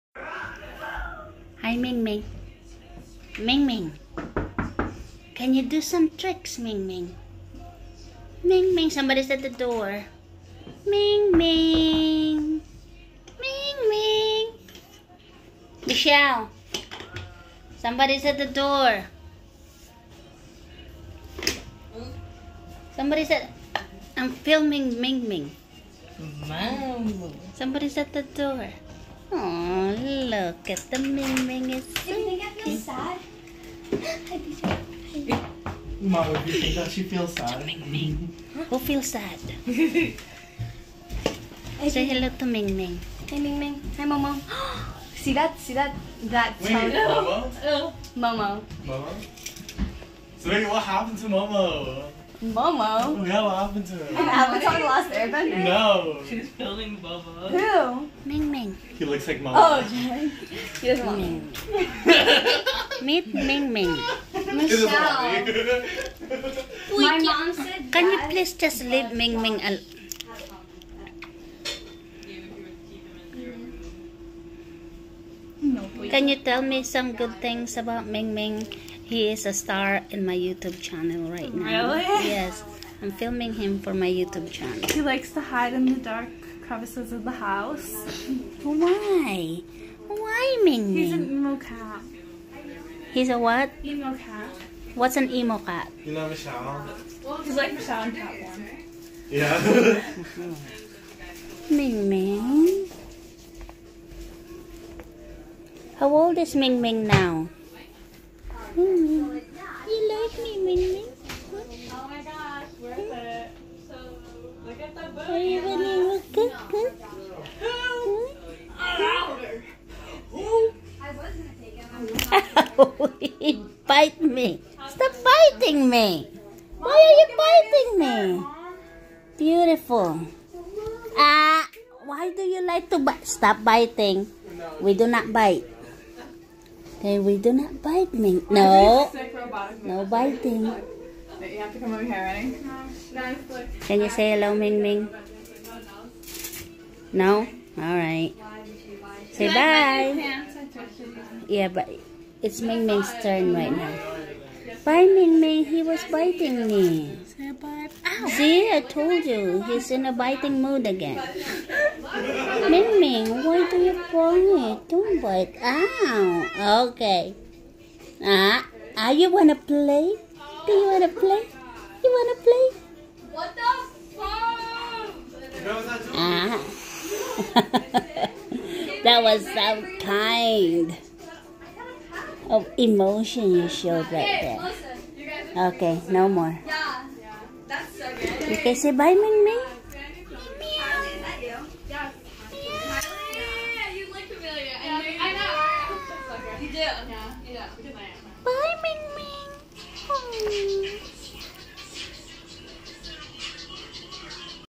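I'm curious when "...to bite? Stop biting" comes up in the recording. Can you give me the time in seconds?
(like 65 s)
132 s.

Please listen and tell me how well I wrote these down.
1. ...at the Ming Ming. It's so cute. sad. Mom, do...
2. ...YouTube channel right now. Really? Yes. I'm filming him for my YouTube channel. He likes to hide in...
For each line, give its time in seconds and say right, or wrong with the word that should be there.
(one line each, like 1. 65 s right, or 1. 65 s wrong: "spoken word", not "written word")
1. 30 s right
2. 80 s right.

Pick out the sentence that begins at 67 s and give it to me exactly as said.
Can you please just leave Ming Ming alone?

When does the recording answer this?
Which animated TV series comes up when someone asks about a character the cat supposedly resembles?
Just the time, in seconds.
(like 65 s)
54 s.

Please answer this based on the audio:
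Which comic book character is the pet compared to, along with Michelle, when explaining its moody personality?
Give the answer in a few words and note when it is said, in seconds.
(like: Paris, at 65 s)
Catwoman, at 98 s.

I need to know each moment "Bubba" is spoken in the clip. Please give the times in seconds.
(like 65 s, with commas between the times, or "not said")
56 s.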